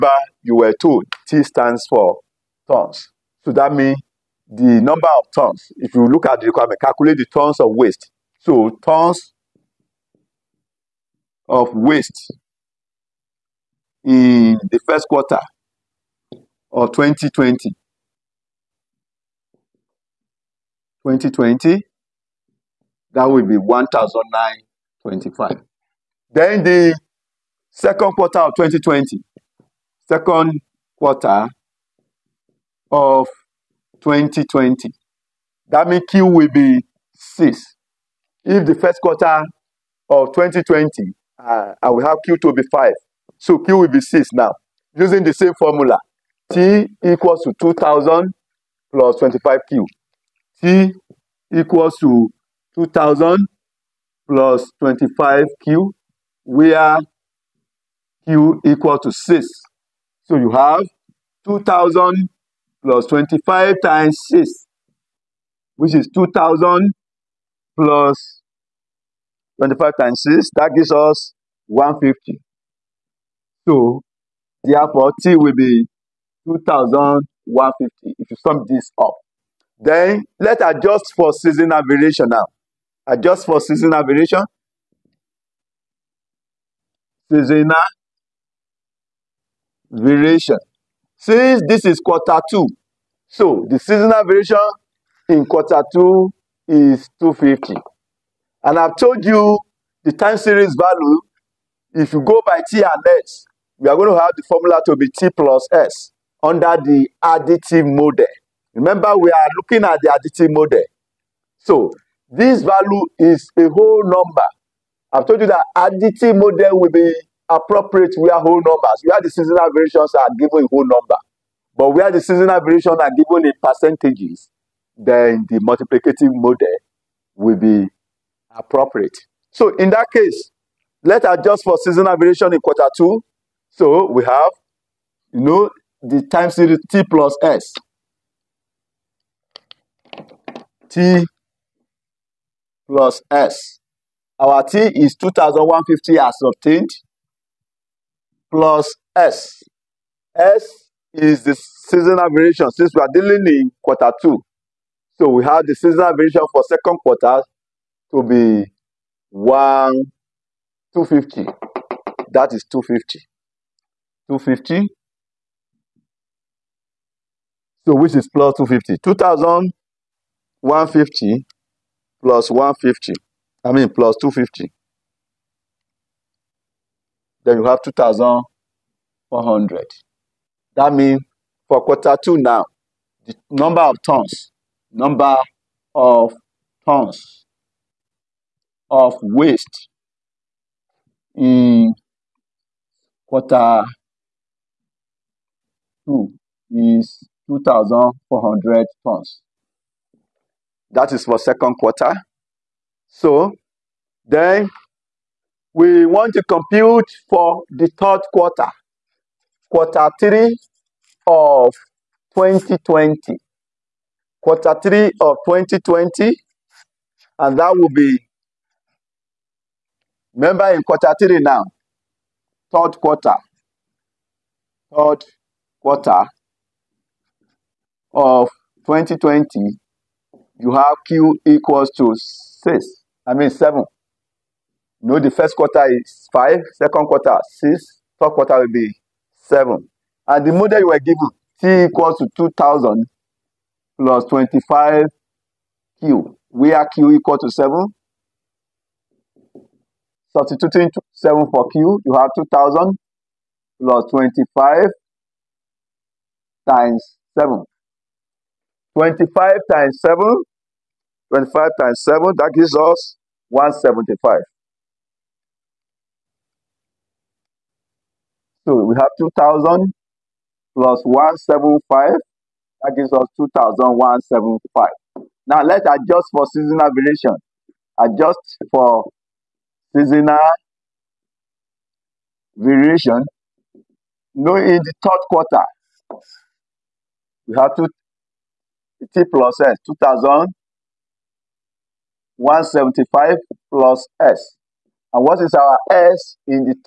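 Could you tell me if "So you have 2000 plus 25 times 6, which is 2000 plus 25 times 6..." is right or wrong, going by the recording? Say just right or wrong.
right.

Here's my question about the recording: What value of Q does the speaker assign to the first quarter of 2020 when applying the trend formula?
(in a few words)
5.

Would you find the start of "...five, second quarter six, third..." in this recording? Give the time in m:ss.
3:56.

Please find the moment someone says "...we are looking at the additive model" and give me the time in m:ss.
1:49.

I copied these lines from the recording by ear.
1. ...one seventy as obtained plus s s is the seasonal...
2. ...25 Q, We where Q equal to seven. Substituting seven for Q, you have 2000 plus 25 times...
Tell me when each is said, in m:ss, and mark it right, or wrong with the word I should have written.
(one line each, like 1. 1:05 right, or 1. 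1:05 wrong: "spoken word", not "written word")
1. 2:25 wrong: "fifty", not "seventy"
2. 4:04 right.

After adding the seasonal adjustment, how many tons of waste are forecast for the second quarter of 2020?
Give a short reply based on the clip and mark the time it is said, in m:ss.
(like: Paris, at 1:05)
2,400 tons, at 3:17.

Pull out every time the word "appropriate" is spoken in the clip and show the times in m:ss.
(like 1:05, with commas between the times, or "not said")
1:57, 2:08.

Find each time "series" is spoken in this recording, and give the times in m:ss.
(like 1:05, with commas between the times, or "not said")
1:40, 2:16.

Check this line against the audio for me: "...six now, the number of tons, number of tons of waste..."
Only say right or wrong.
wrong.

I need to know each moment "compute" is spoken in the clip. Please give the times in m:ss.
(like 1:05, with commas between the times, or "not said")
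3:26.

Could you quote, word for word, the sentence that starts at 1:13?
So, therefore, T will be 2,150 if you sum this up.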